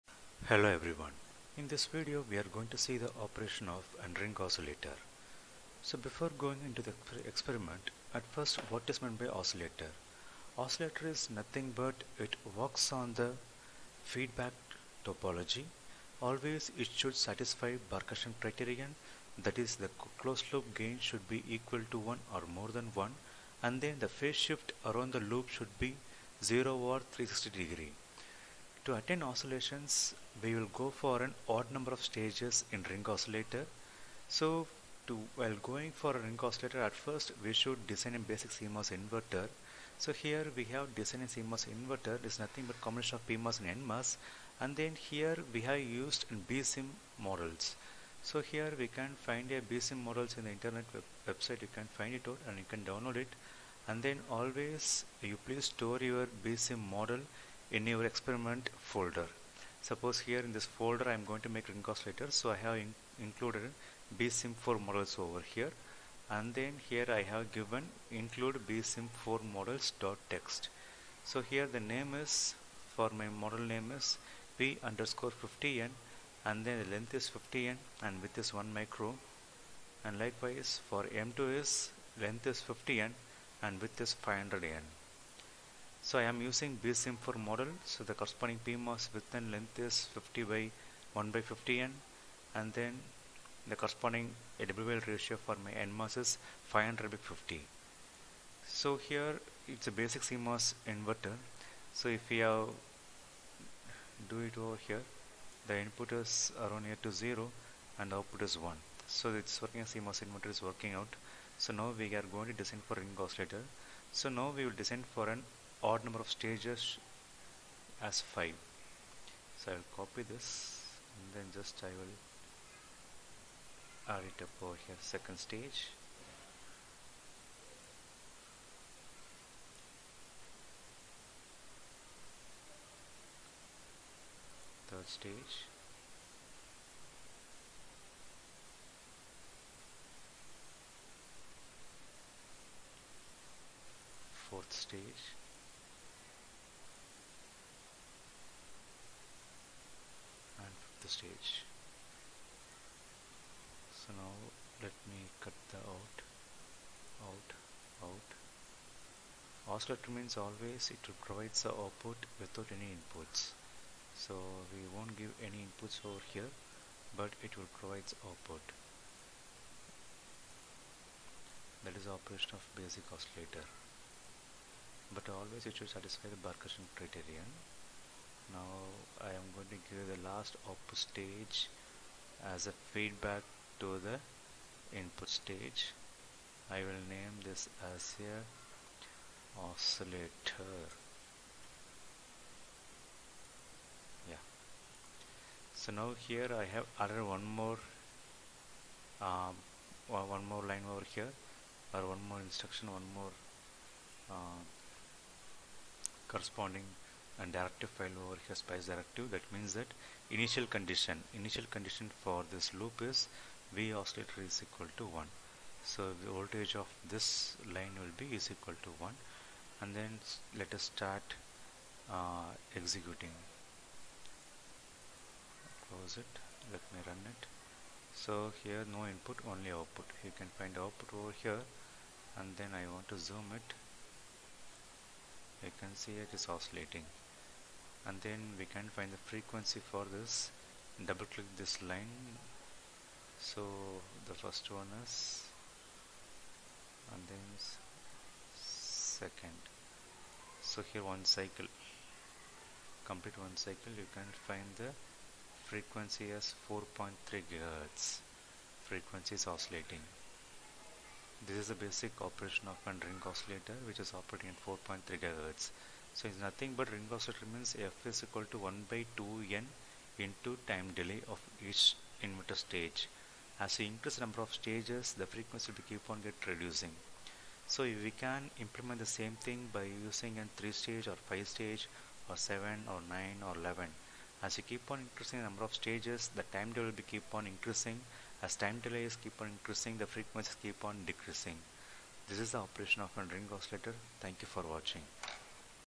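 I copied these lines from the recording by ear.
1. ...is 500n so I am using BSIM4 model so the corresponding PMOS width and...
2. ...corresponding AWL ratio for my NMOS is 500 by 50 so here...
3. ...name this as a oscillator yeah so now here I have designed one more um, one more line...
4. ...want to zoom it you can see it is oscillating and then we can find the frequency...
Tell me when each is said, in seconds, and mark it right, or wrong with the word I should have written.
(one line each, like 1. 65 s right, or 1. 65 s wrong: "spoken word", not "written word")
1. 84 s right
2. 93 s right
3. 187 s wrong: "added", not "designed"
4. 232 s right.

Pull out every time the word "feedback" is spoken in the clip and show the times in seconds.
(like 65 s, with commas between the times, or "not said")
14 s, 182 s.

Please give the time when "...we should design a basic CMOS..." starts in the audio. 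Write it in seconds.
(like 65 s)
37 s.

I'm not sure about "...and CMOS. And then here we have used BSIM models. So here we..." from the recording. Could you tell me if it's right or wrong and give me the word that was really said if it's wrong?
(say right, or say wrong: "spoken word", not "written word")
wrong: "NMOS", not "CMOS".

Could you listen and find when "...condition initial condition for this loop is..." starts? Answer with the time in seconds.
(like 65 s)
210 s.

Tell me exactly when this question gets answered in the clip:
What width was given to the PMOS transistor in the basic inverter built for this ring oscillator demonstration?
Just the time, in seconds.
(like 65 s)
78 s.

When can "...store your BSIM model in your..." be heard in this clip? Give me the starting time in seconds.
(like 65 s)
55 s.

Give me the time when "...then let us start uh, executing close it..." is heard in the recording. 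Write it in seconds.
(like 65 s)
219 s.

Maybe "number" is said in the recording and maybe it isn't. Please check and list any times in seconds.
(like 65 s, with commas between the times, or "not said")
31 s, 116 s, 274 s, 285 s.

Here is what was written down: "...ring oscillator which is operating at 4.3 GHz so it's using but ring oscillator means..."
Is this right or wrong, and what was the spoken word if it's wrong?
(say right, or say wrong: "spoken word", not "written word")
wrong: "nothing", not "using".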